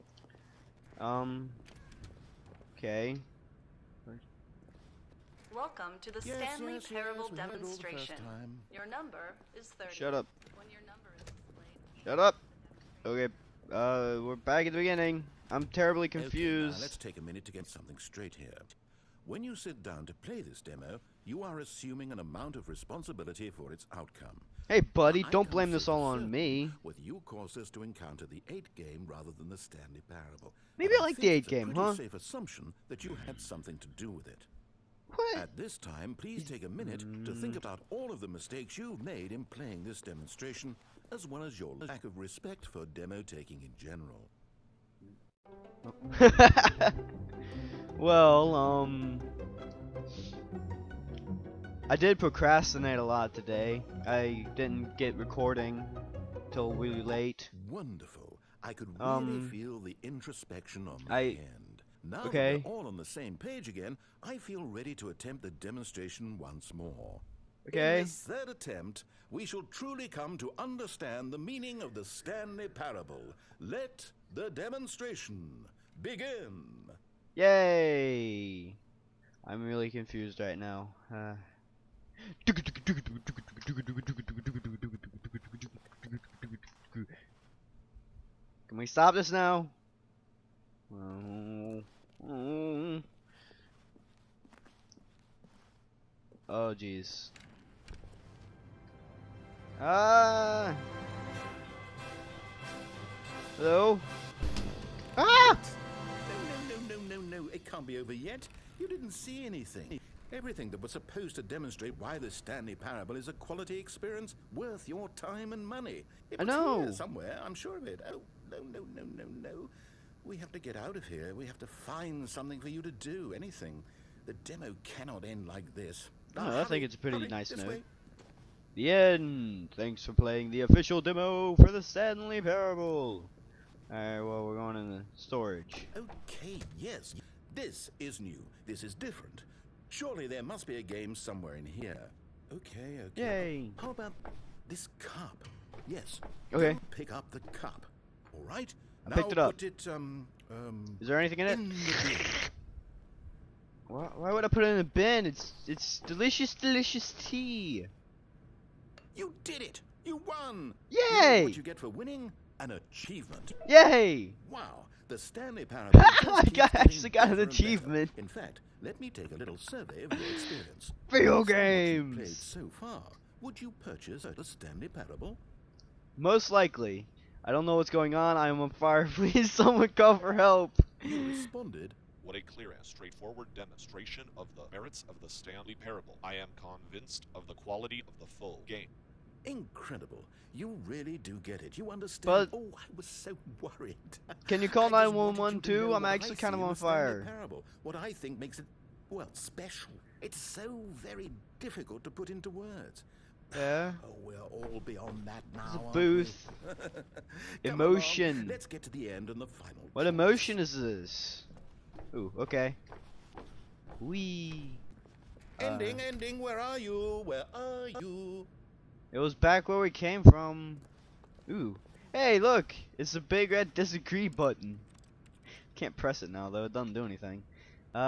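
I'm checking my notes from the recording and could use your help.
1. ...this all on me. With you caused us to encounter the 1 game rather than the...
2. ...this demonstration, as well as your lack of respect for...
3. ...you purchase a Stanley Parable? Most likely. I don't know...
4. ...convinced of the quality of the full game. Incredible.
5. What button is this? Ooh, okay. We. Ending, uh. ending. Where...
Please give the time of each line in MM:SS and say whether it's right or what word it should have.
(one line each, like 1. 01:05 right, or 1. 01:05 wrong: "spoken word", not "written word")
1. 00:25 wrong: "8", not "1"
2. 00:39 right
3. 02:53 right
4. 03:06 right
5. 03:29 wrong: "emotion", not "button".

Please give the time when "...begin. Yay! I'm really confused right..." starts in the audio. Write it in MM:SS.
01:16.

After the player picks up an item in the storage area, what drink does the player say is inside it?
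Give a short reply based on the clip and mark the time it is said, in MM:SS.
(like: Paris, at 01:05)
Tea, at 02:37.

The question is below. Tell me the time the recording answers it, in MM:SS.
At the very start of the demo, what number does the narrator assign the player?
00:09.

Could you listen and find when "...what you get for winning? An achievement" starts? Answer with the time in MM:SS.
02:41.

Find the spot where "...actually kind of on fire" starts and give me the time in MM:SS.
03:16.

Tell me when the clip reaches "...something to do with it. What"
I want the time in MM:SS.
00:33.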